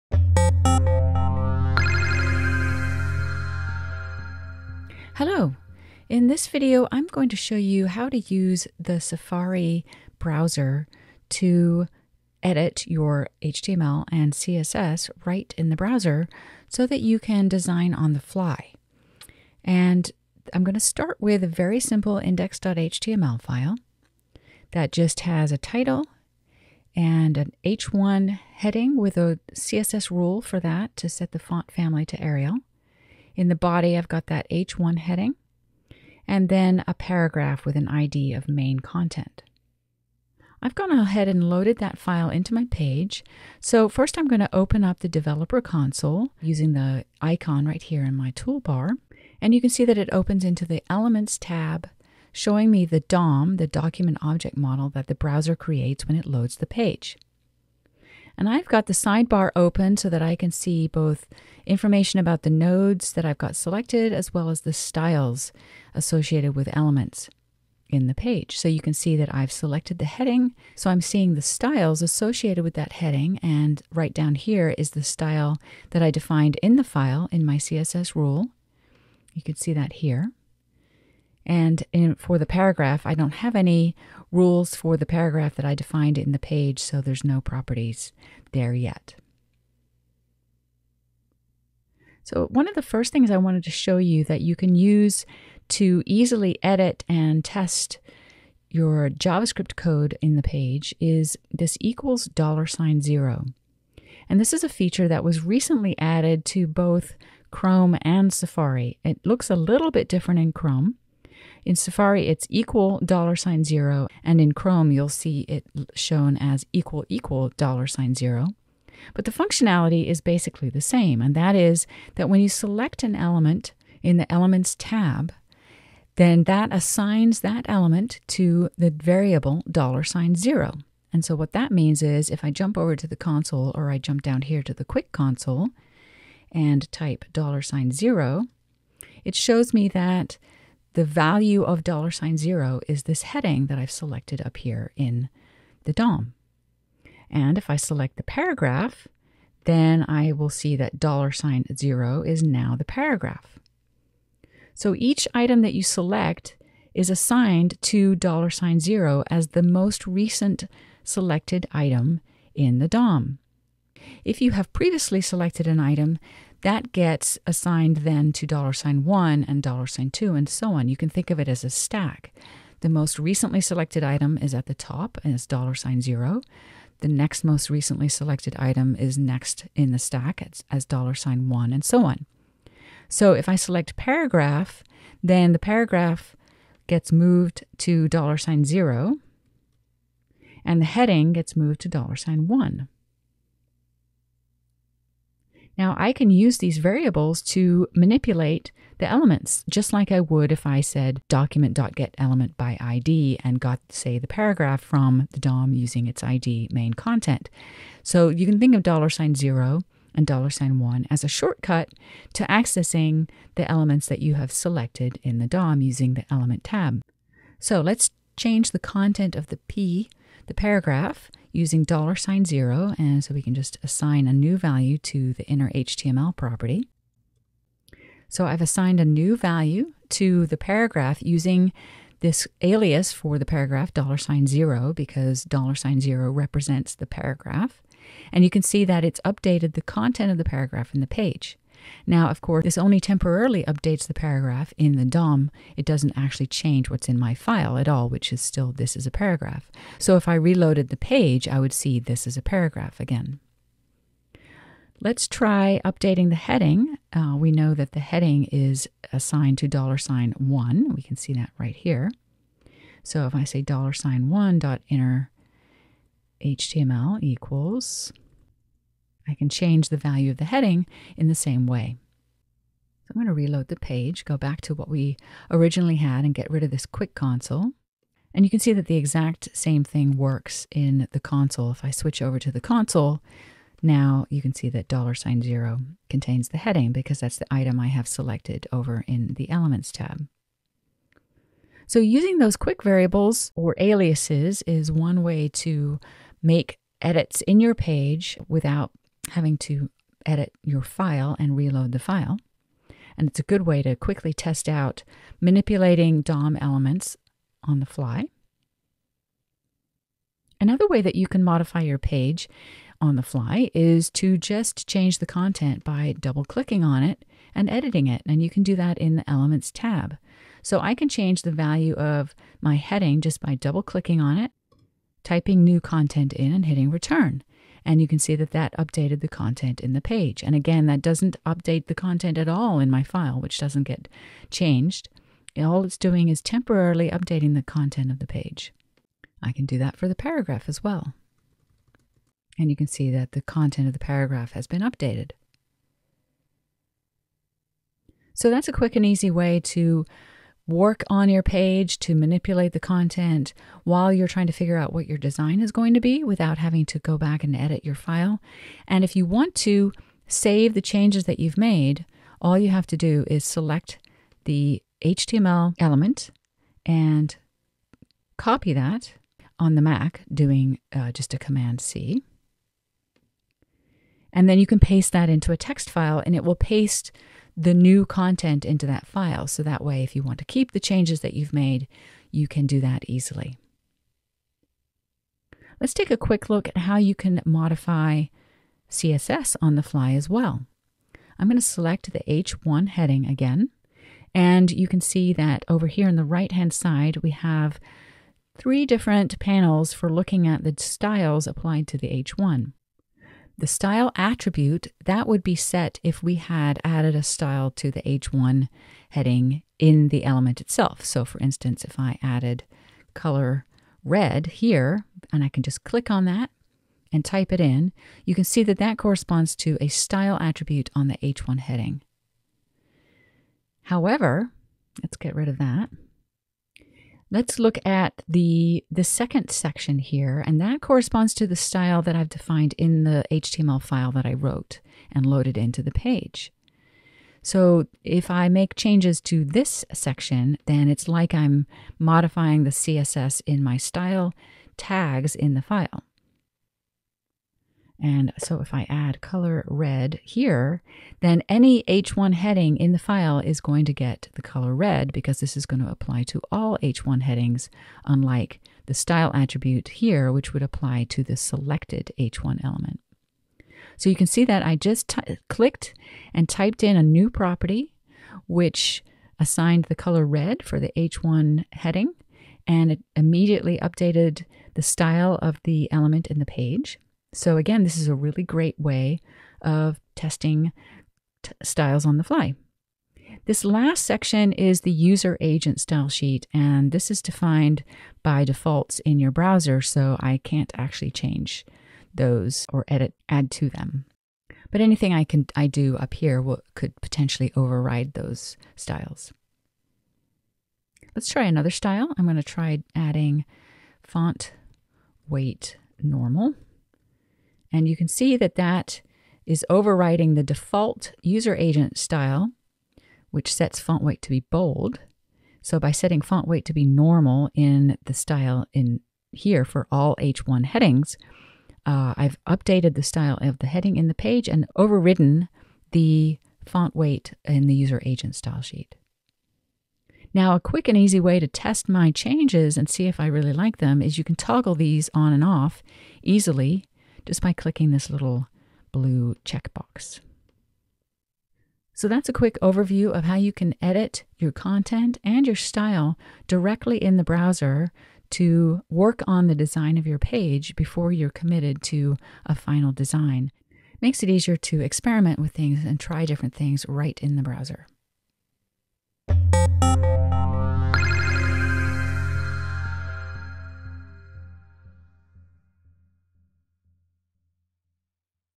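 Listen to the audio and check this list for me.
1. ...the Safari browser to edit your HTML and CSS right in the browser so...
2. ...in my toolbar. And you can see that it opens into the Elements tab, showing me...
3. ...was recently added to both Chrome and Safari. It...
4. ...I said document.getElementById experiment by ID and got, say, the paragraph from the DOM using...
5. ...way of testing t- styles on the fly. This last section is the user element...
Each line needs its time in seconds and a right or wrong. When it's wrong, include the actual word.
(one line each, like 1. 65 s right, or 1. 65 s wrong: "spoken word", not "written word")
1. 8 s right
2. 48 s right
3. 105 s right
4. 200 s wrong: "element", not "experiment"
5. 478 s wrong: "agent", not "element".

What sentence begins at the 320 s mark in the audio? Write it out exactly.
So I can change the value of my heading just by double clicking on it, typing new content in, and hitting return.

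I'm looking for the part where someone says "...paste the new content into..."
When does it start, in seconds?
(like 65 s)
376 s.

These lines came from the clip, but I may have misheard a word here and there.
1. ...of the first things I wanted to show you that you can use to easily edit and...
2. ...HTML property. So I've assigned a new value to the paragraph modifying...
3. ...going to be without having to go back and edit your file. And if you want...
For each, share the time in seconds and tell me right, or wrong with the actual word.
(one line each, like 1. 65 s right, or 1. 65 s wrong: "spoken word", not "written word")
1. 92 s right
2. 225 s wrong: "using", not "modifying"
3. 355 s right.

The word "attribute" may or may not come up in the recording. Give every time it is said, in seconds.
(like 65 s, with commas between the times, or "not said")
404 s, 420 s, 459 s.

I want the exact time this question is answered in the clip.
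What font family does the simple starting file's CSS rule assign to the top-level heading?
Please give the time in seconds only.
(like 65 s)
32 s.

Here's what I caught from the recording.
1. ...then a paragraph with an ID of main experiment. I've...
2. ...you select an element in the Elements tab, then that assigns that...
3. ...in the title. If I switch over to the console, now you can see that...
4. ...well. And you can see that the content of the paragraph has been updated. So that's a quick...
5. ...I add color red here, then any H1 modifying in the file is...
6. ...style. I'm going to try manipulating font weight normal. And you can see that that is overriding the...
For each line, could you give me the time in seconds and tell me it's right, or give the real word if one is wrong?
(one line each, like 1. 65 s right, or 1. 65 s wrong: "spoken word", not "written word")
1. 36 s wrong: "content", not "experiment"
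2. 122 s right
3. 280 s wrong: "console", not "title"
4. 340 s right
5. 448 s wrong: "heading", not "modifying"
6. 501 s wrong: "adding", not "manipulating".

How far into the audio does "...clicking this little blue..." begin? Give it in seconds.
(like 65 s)
537 s.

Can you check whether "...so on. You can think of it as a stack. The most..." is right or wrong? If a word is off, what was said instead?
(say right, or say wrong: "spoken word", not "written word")
right.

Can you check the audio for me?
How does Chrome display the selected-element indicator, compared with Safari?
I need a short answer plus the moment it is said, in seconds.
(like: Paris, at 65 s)
equal equal dollar sign zero, at 116 s.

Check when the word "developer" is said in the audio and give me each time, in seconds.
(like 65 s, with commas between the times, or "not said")
45 s.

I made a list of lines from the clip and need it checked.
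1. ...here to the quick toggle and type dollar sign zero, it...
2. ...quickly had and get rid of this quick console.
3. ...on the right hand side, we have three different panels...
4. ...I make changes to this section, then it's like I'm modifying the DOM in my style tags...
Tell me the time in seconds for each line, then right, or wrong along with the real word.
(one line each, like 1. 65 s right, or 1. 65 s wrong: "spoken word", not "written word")
1. 134 s wrong: "console", not "toggle"
2. 275 s wrong: "originally", not "quickly"
3. 396 s right
4. 438 s wrong: "CSS", not "DOM".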